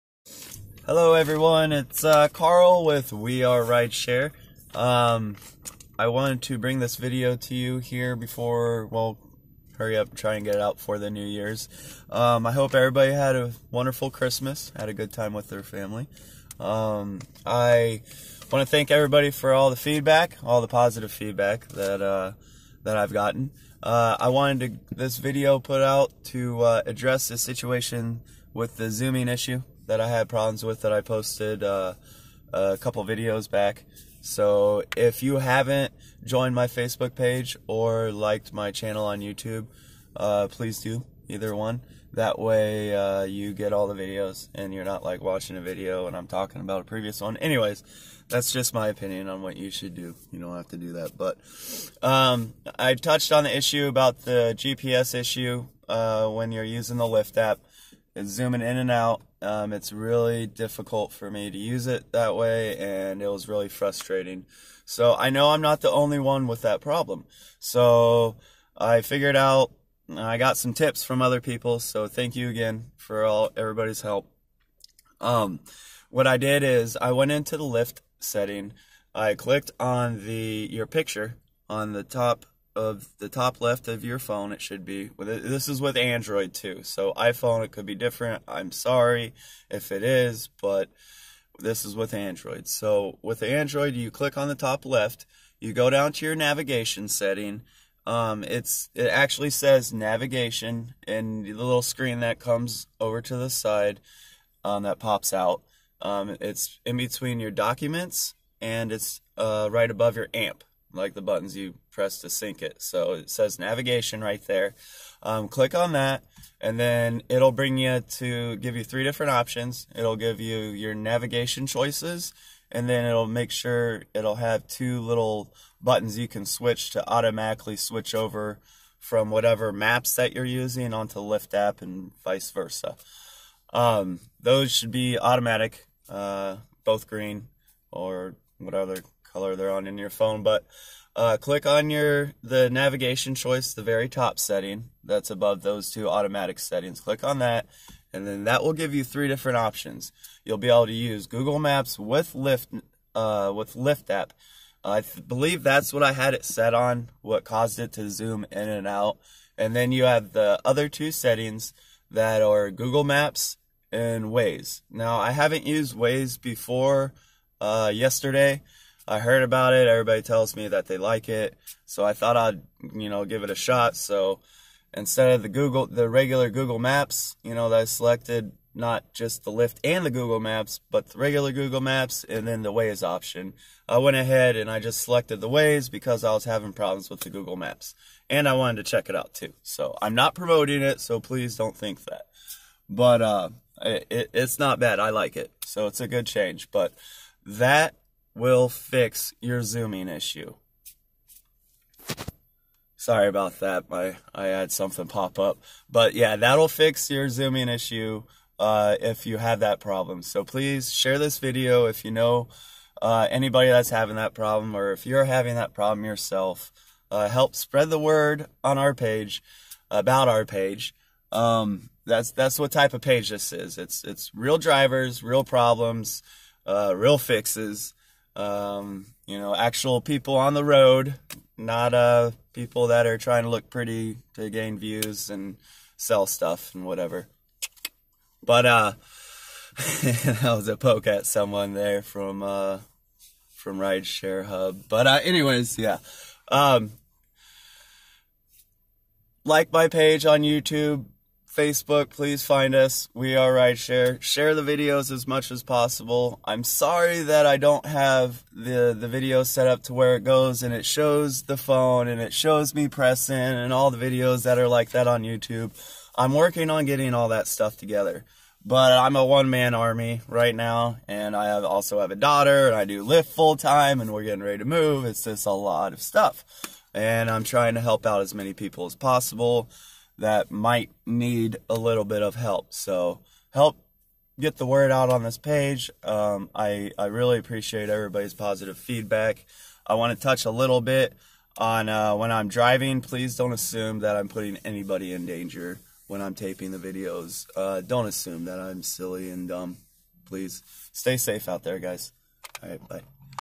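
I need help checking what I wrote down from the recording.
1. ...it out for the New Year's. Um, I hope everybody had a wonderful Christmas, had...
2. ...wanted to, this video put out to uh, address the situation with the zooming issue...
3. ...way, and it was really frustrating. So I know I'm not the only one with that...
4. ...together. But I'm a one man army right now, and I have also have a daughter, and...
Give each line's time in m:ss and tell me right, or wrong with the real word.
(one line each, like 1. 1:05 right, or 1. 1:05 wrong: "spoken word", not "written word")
1. 0:10 right
2. 0:24 right
3. 1:02 right
4. 4:27 right.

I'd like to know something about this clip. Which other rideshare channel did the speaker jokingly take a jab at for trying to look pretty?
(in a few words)
Rideshare Hub.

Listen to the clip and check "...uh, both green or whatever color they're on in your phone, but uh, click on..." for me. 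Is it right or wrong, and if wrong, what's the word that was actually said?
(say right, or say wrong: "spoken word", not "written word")
right.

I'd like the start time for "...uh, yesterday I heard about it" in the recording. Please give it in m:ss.
2:47.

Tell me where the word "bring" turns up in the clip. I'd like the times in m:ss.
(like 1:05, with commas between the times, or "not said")
0:06, 1:57.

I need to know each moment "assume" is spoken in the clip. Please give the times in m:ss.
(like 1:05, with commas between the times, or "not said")
4:53, 4:58.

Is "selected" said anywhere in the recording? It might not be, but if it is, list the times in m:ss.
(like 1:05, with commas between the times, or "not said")
2:57, 3:05.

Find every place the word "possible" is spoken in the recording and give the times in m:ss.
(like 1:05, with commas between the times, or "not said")
4:15, 4:38.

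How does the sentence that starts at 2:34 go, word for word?
I th- believe that's what I had it set on.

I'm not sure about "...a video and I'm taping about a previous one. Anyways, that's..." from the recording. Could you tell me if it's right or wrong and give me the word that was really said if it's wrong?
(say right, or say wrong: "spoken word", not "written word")
wrong: "talking", not "taping".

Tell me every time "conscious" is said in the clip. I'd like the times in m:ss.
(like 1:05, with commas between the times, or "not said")
not said.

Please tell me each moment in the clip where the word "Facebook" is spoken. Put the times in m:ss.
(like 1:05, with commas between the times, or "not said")
0:36, 4:11.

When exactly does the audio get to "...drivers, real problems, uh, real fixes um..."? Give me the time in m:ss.
3:44.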